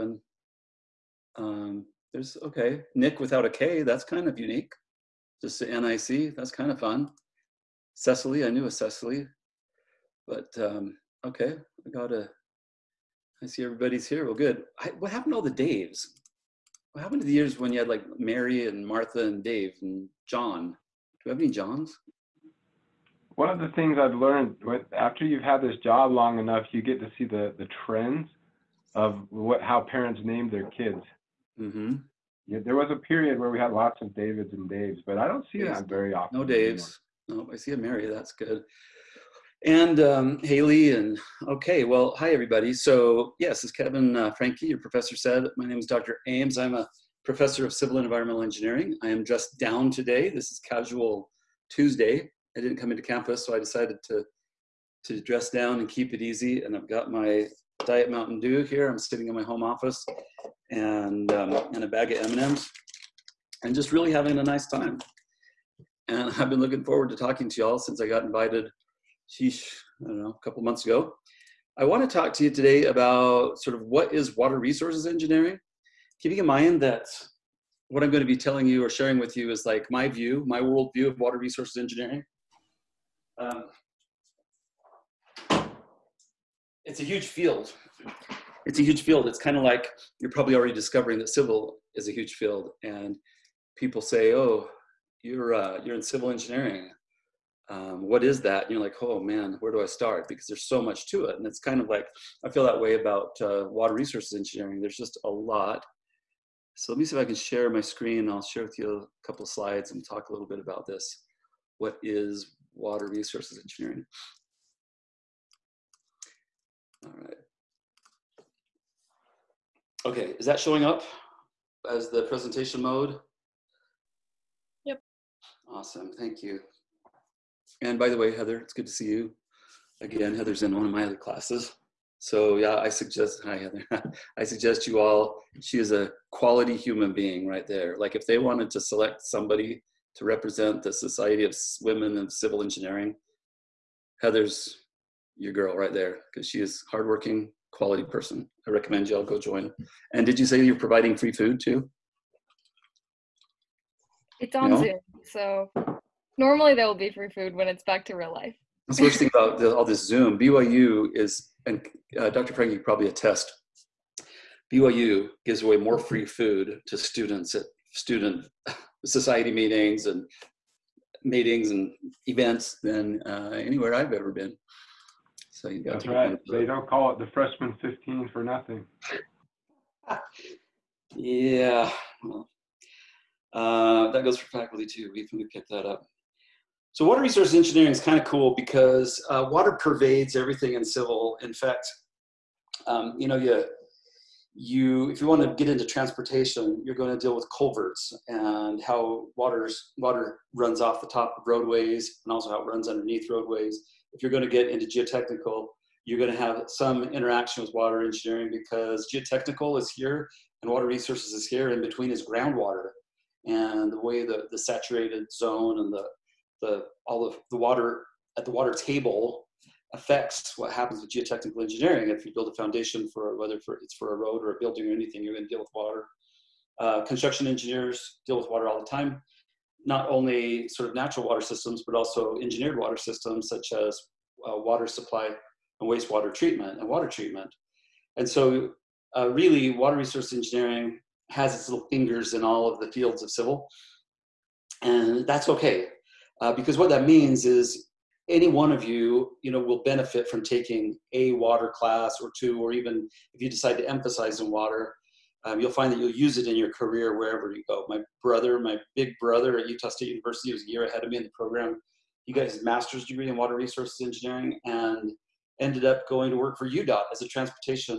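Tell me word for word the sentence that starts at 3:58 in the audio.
And so, uh, really, water resource engineering has its little fingers in all of the fields of civil.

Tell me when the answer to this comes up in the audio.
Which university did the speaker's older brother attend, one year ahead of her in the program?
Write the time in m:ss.
4:19.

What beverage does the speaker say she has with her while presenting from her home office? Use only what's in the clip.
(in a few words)
Diet Mountain Dew.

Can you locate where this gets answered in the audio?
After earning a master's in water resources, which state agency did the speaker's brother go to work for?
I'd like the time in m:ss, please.
4:26.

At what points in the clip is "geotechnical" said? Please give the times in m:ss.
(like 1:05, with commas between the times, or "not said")
3:24, 3:29, 3:41.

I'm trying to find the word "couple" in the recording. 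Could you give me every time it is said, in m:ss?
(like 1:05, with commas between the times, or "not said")
1:10, 1:49.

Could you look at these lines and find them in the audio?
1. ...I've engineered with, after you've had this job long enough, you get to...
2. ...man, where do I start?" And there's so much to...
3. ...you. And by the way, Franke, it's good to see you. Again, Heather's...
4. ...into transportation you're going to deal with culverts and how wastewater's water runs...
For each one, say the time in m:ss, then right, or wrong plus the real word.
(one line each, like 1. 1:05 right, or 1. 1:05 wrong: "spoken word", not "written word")
1. 0:23 wrong: "learned", not "engineered"
2. 1:39 wrong: "Because", not "And"
3. 2:06 wrong: "Heather", not "Franke"
4. 3:15 wrong: "water", not "wastewater".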